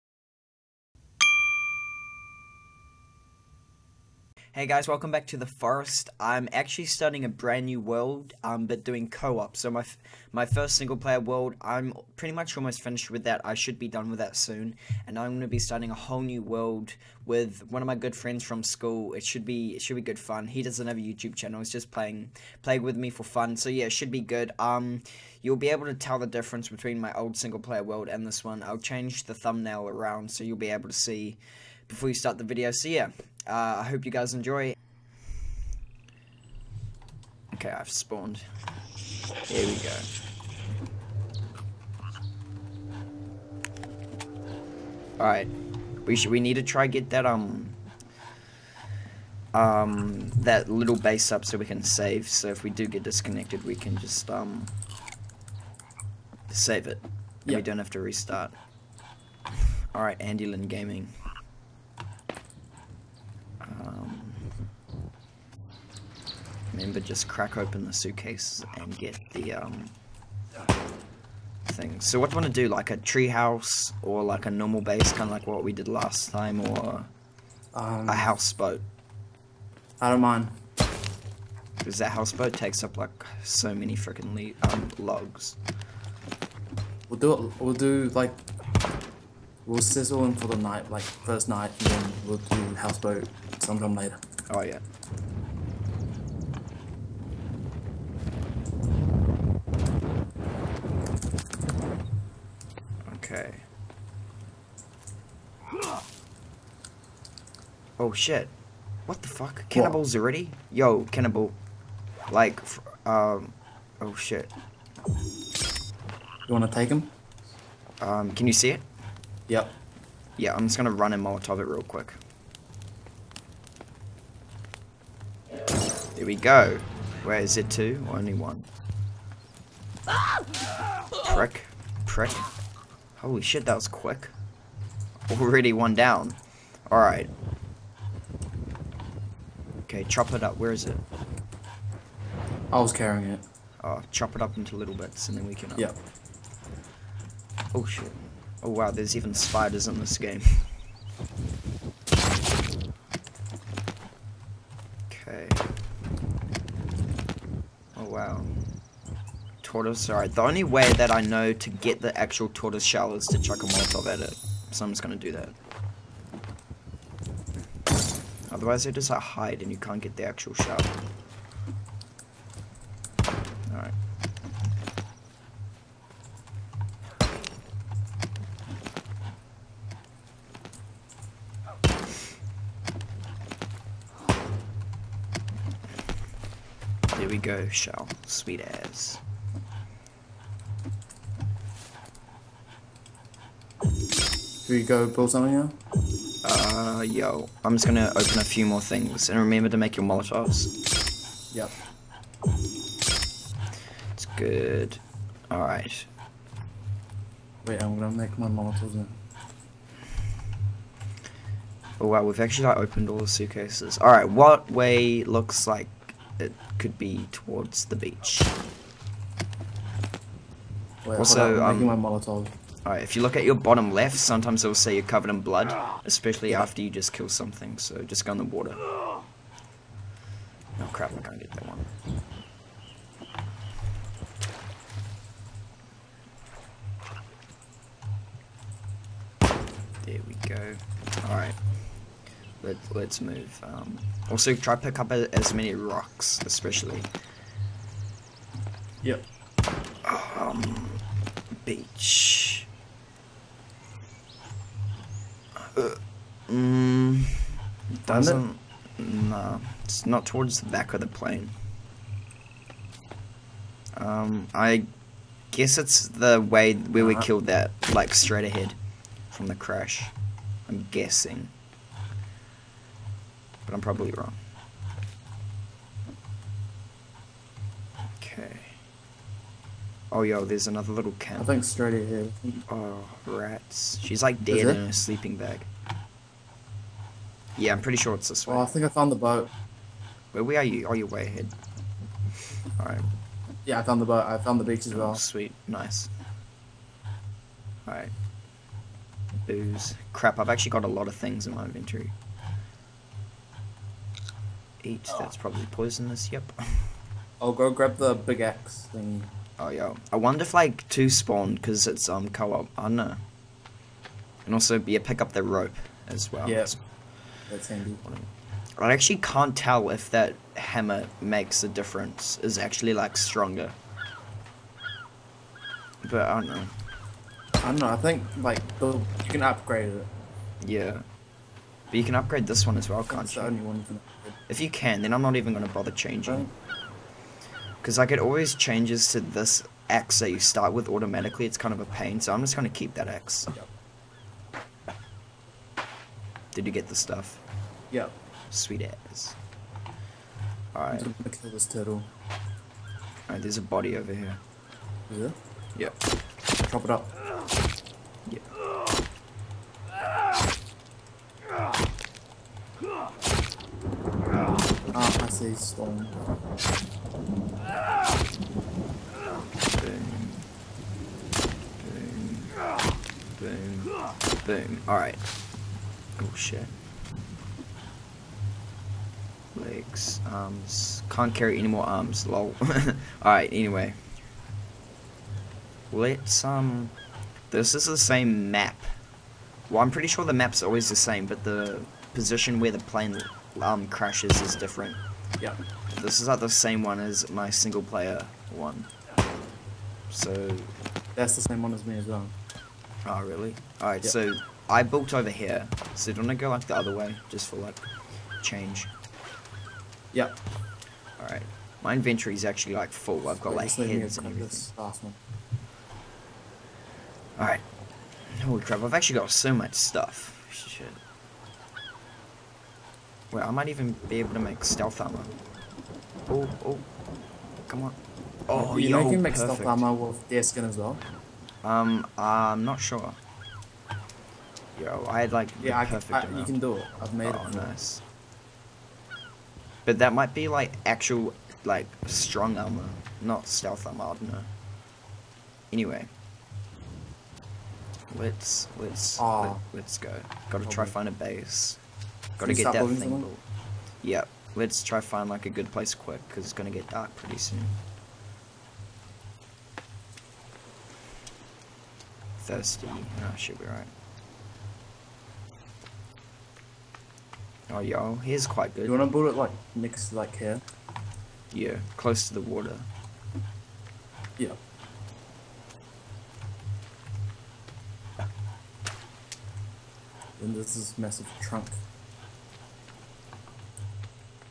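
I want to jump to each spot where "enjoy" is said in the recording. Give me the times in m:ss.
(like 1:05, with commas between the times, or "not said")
0:34.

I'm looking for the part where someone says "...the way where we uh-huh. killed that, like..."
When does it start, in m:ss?
4:26.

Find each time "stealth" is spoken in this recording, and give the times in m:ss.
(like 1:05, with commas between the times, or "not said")
7:04, 7:09, 7:23.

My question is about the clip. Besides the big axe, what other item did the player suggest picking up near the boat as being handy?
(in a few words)
Rope.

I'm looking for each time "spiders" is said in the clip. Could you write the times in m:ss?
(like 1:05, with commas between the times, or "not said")
2:29.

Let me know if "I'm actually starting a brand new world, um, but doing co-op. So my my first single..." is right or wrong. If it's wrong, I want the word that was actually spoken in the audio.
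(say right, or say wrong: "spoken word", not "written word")
right.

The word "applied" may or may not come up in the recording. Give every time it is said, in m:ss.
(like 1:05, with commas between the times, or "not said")
not said.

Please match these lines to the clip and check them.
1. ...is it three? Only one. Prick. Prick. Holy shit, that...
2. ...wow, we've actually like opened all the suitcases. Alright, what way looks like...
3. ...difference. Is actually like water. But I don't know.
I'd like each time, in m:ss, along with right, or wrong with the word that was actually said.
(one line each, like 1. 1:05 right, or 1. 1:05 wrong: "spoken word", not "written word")
1. 2:07 wrong: "two", not "three"
2. 3:32 right
3. 5:21 wrong: "stronger", not "water".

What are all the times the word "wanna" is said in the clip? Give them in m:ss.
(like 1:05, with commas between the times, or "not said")
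1:56, 7:48.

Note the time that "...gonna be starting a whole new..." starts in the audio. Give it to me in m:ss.
0:15.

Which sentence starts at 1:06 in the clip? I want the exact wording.
remember, just crack open the suitcase and get the um, thing.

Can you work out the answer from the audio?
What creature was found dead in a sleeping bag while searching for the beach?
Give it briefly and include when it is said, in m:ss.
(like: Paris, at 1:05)
Rats, at 4:43.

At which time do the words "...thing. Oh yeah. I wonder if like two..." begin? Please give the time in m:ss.
5:08.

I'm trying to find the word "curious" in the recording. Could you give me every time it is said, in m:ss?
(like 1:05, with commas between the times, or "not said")
not said.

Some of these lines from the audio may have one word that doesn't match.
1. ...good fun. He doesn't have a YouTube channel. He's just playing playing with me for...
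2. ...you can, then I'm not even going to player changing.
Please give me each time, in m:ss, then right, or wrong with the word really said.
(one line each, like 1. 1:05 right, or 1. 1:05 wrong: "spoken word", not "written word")
1. 0:20 right
2. 5:34 wrong: "bother", not "player".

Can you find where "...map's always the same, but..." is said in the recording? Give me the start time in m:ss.
6:30.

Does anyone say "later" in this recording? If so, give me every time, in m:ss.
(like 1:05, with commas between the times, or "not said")
1:33.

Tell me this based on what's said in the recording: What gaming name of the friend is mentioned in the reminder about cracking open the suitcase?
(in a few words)
Andy Lynn Gaming.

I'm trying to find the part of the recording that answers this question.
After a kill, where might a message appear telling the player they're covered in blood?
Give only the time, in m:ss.
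3:43.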